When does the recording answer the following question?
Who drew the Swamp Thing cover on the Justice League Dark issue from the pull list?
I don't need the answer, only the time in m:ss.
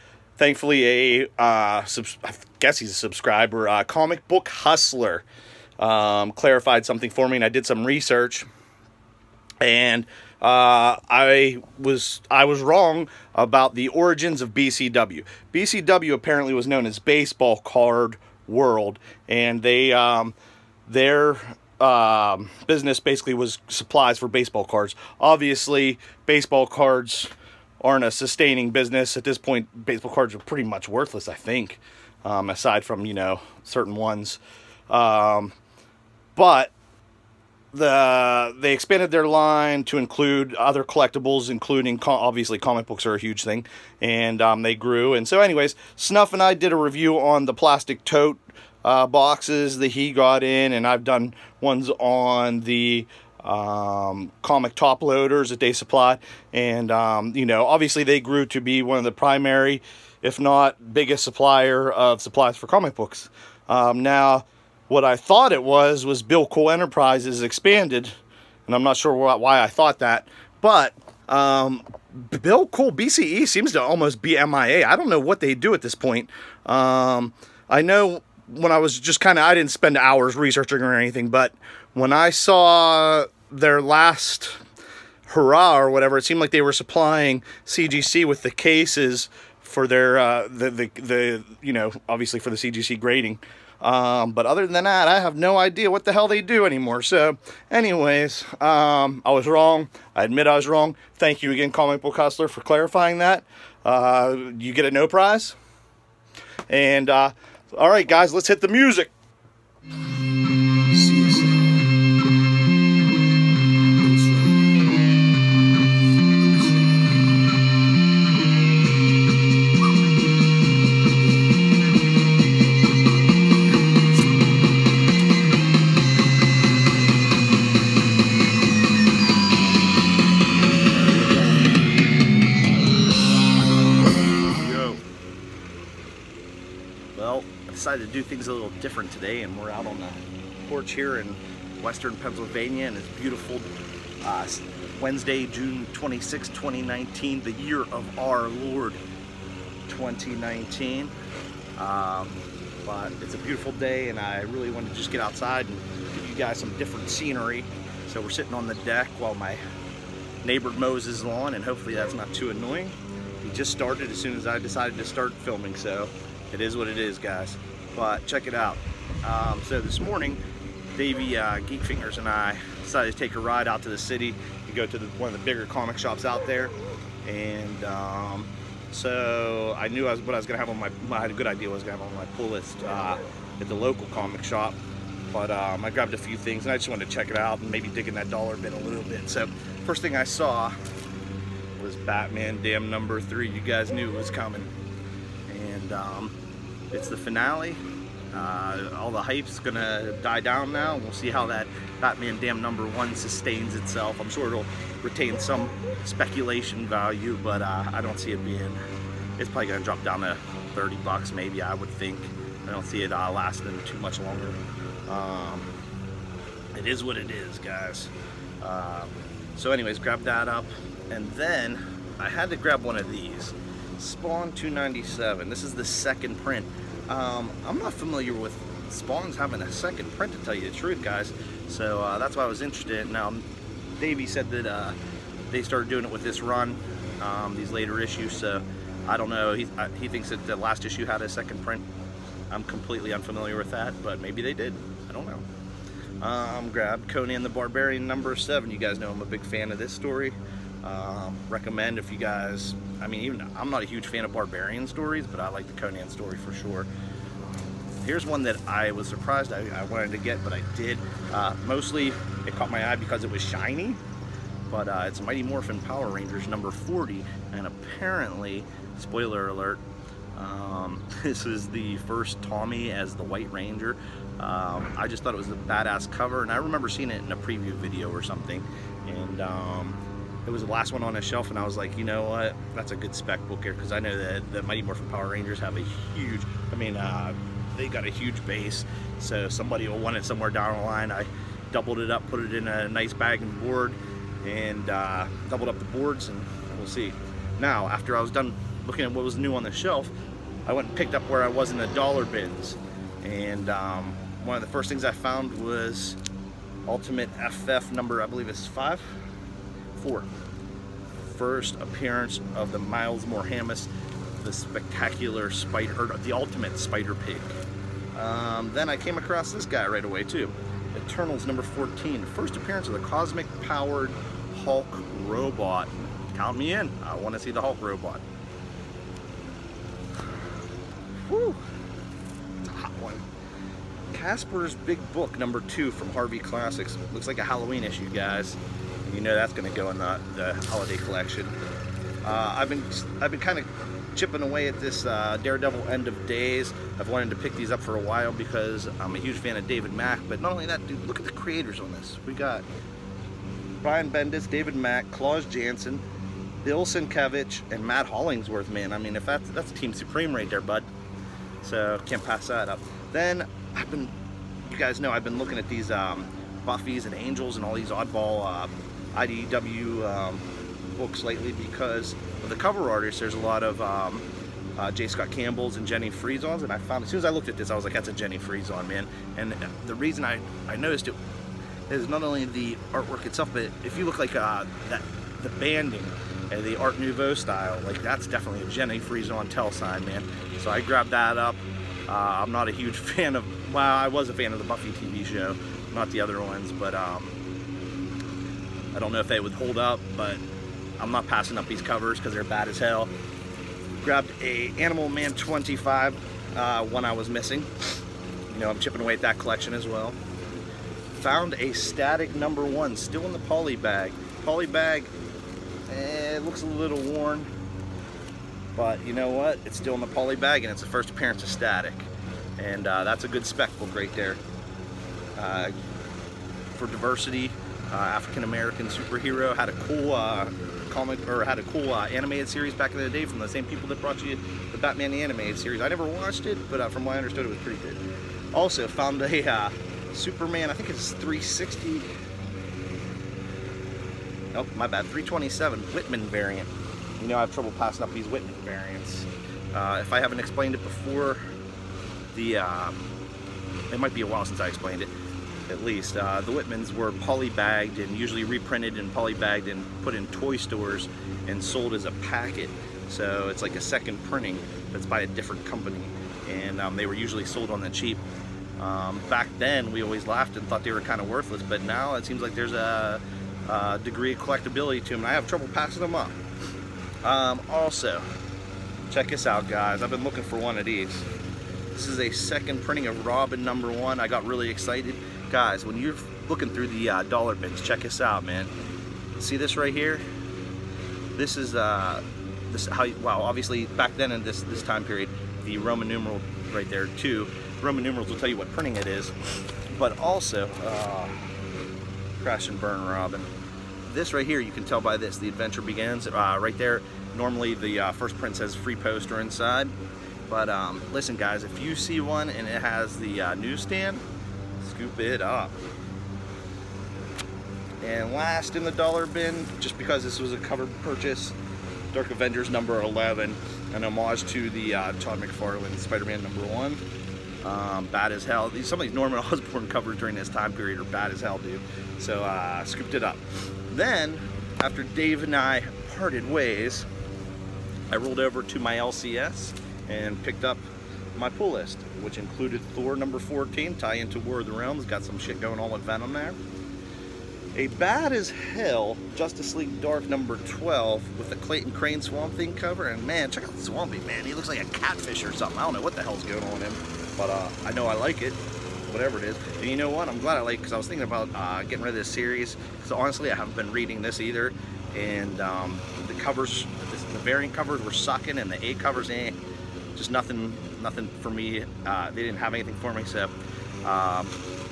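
9:11.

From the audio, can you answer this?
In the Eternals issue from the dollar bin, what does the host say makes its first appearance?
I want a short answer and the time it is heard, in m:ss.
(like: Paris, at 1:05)
cosmic powered Hulk robot, at 5:23.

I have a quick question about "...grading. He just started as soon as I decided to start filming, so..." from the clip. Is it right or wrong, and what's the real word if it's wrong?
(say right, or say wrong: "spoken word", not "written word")
wrong: "annoying", not "grading".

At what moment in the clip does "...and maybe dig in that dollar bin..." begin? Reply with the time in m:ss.
3:07.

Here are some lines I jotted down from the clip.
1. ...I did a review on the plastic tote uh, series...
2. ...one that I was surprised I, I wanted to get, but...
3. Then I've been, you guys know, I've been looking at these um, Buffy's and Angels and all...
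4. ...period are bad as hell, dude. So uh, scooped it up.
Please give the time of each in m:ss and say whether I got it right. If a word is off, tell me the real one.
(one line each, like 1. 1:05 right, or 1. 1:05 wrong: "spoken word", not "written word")
1. 0:46 wrong: "boxes", not "series"
2. 4:18 right
3. 6:03 right
4. 8:50 right.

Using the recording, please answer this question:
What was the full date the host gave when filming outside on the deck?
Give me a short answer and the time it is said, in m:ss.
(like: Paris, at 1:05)
Wednesday, June 26, 2019, at 2:25.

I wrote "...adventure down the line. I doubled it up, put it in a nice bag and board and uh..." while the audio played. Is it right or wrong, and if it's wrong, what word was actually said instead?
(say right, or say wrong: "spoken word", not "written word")
wrong: "somewhere", not "adventure".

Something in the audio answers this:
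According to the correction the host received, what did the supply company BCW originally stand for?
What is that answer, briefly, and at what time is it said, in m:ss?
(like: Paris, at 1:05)
Baseball Card World, at 0:16.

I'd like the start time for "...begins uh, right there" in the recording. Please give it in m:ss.
8:25.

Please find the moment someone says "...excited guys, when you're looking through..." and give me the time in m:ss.
8:04.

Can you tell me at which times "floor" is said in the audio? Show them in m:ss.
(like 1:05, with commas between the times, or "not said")
not said.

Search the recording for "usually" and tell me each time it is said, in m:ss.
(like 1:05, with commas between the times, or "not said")
7:38, 7:47.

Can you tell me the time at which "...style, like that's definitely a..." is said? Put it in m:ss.
6:27.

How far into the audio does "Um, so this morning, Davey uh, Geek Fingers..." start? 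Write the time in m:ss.
2:49.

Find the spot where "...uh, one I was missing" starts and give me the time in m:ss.
6:46.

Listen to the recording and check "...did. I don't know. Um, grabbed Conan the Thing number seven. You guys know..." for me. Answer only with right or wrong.
wrong.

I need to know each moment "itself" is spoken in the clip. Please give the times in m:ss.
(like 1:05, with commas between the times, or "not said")
3:23, 6:23.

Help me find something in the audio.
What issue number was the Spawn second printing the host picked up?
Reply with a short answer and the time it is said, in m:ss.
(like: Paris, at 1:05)
297, at 3:44.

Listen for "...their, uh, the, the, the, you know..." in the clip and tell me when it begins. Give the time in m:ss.
1:29.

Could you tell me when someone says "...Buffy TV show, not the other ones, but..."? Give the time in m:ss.
6:34.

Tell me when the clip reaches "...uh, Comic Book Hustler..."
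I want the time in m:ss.
0:03.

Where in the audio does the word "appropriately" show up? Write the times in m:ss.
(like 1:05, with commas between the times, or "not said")
not said.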